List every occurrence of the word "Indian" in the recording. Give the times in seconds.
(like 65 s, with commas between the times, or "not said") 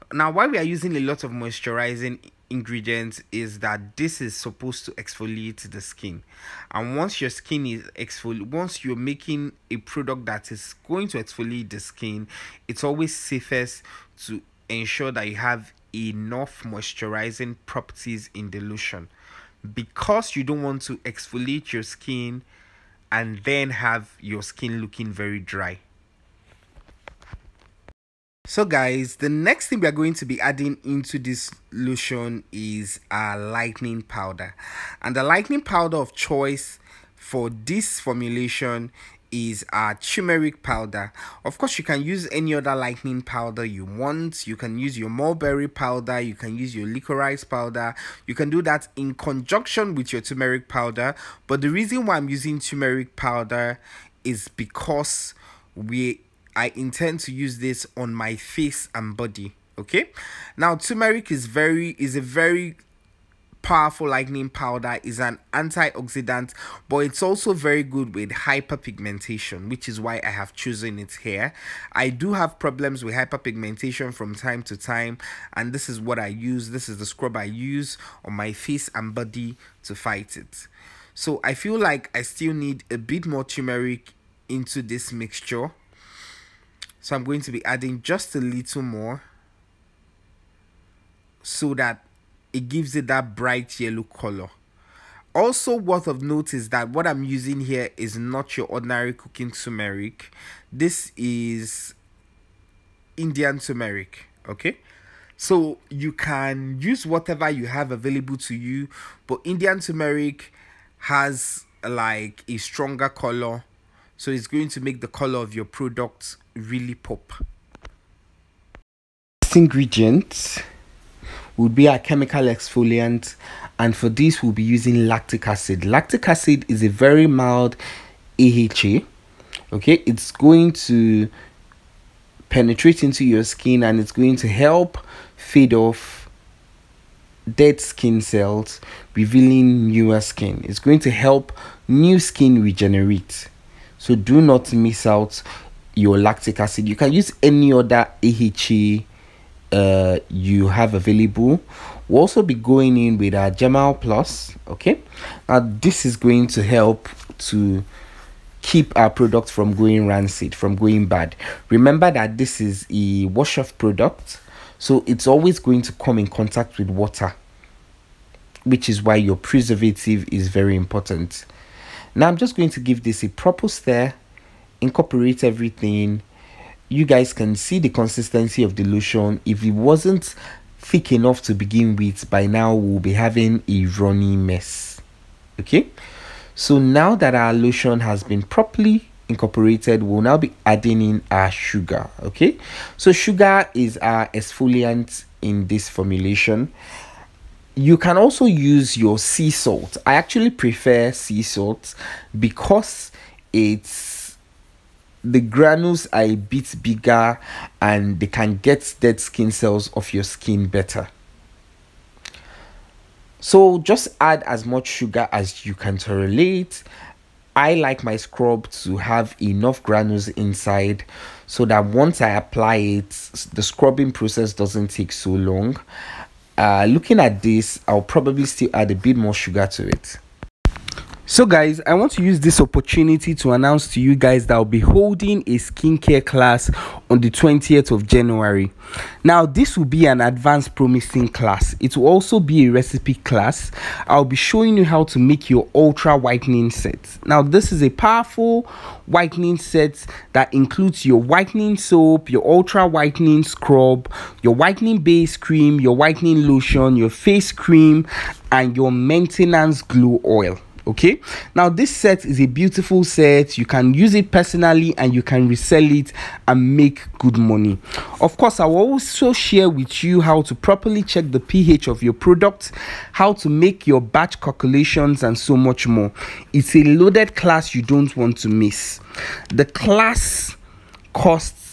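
103 s, 109 s.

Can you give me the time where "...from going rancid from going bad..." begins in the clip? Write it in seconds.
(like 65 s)
159 s.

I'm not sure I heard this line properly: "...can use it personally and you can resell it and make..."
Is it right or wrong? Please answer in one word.
right.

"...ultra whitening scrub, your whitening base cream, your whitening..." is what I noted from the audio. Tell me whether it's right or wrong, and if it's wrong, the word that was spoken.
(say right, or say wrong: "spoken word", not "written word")
right.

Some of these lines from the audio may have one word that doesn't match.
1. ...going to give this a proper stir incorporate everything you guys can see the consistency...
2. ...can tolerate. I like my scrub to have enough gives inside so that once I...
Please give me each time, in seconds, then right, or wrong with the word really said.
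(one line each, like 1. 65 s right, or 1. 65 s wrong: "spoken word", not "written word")
1. 172 s right
2. 215 s wrong: "granules", not "gives".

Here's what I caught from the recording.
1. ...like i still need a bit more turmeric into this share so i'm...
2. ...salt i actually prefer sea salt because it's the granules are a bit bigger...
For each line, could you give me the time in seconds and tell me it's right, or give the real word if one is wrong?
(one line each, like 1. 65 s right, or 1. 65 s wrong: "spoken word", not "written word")
1. 81 s wrong: "mixture", not "share"
2. 199 s right.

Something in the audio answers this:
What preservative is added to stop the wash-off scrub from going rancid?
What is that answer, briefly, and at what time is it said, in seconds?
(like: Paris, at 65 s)
Germall Plus, at 153 s.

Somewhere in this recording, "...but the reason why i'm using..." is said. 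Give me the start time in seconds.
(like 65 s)
51 s.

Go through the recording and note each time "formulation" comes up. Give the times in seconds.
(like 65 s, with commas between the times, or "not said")
37 s, 195 s.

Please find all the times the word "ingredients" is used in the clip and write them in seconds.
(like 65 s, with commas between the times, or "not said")
2 s, 119 s.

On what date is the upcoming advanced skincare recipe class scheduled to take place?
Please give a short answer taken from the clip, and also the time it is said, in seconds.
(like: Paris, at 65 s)
20 January, at 237 s.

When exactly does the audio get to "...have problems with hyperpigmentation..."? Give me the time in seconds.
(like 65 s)
72 s.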